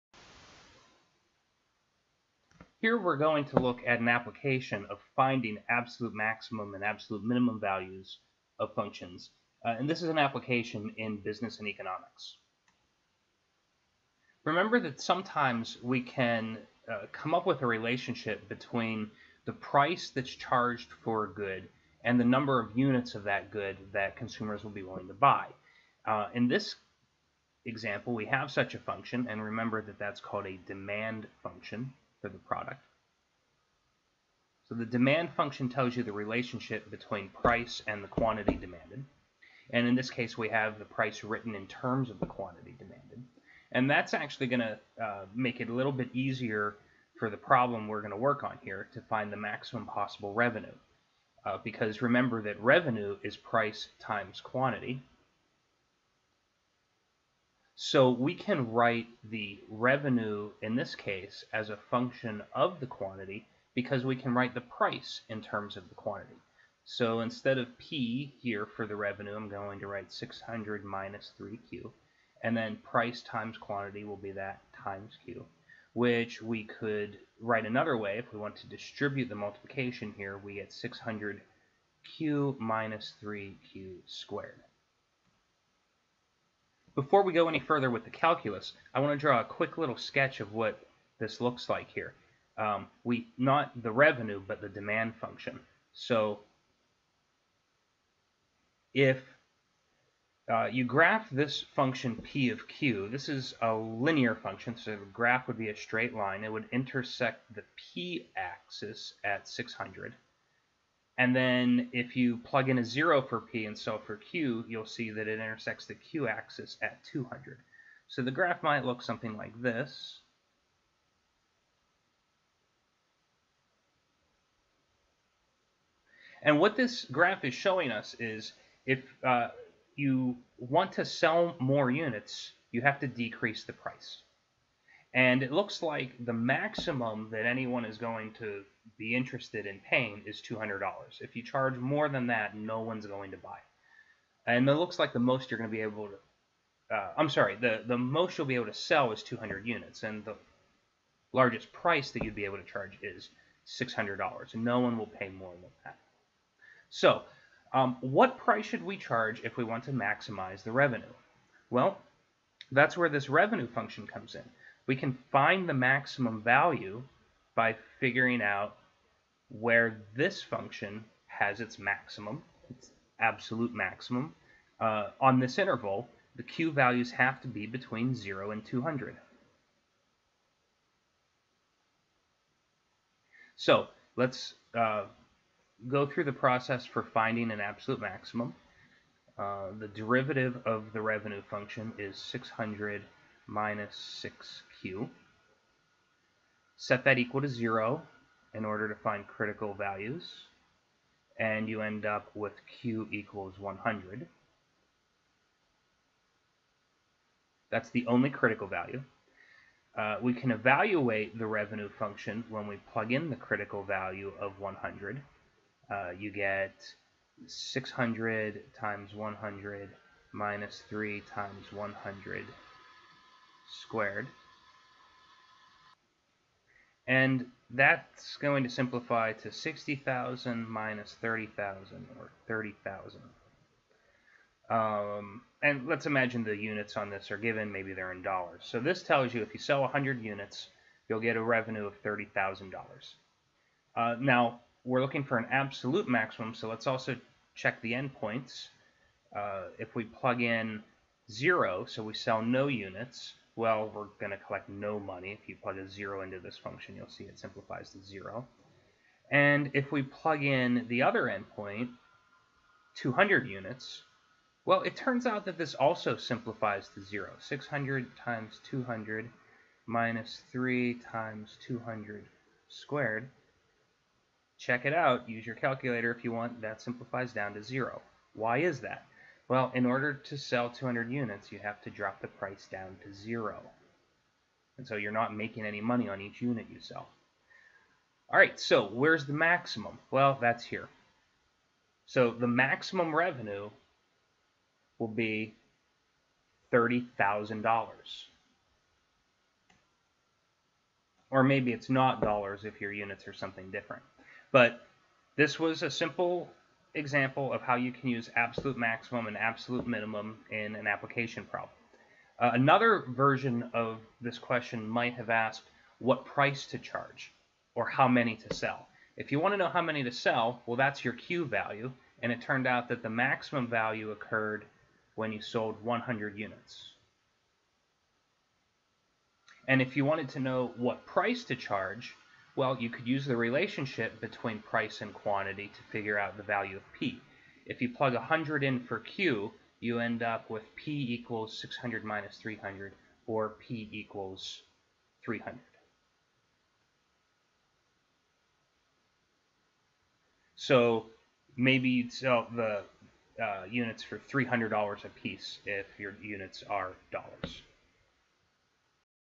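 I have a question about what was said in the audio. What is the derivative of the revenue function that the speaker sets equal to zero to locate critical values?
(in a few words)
600 minus 6q.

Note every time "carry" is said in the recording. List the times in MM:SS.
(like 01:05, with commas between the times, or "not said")
not said.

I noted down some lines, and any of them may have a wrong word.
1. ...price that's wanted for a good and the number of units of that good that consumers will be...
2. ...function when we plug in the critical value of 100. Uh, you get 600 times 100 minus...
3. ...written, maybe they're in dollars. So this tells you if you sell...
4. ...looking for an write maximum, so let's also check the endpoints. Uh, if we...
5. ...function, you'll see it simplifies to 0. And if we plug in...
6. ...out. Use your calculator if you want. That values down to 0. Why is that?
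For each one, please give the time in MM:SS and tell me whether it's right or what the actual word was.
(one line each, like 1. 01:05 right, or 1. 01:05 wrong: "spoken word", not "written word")
1. 00:19 wrong: "charged", not "wanted"
2. 03:31 right
3. 03:57 wrong: "given", not "written"
4. 04:05 wrong: "absolute", not "write"
5. 04:16 right
6. 04:34 wrong: "simplifies", not "values".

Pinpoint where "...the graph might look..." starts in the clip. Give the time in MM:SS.
01:58.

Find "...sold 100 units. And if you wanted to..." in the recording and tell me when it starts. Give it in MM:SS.
05:25.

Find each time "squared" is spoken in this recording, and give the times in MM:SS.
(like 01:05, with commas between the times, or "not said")
01:24, 03:43, 04:32.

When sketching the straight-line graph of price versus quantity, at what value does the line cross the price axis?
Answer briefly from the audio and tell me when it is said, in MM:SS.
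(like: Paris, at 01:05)
600, at 01:46.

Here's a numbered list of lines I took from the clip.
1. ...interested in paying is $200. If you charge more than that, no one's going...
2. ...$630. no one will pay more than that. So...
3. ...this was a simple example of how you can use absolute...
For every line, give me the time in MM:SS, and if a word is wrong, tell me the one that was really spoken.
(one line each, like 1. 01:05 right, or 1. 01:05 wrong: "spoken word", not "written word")
1. 02:19 right
2. 02:33 wrong: "600", not "630"
3. 05:05 right.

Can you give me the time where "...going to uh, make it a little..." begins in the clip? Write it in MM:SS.
00:44.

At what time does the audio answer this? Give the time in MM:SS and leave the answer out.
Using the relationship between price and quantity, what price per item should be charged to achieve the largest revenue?
05:43.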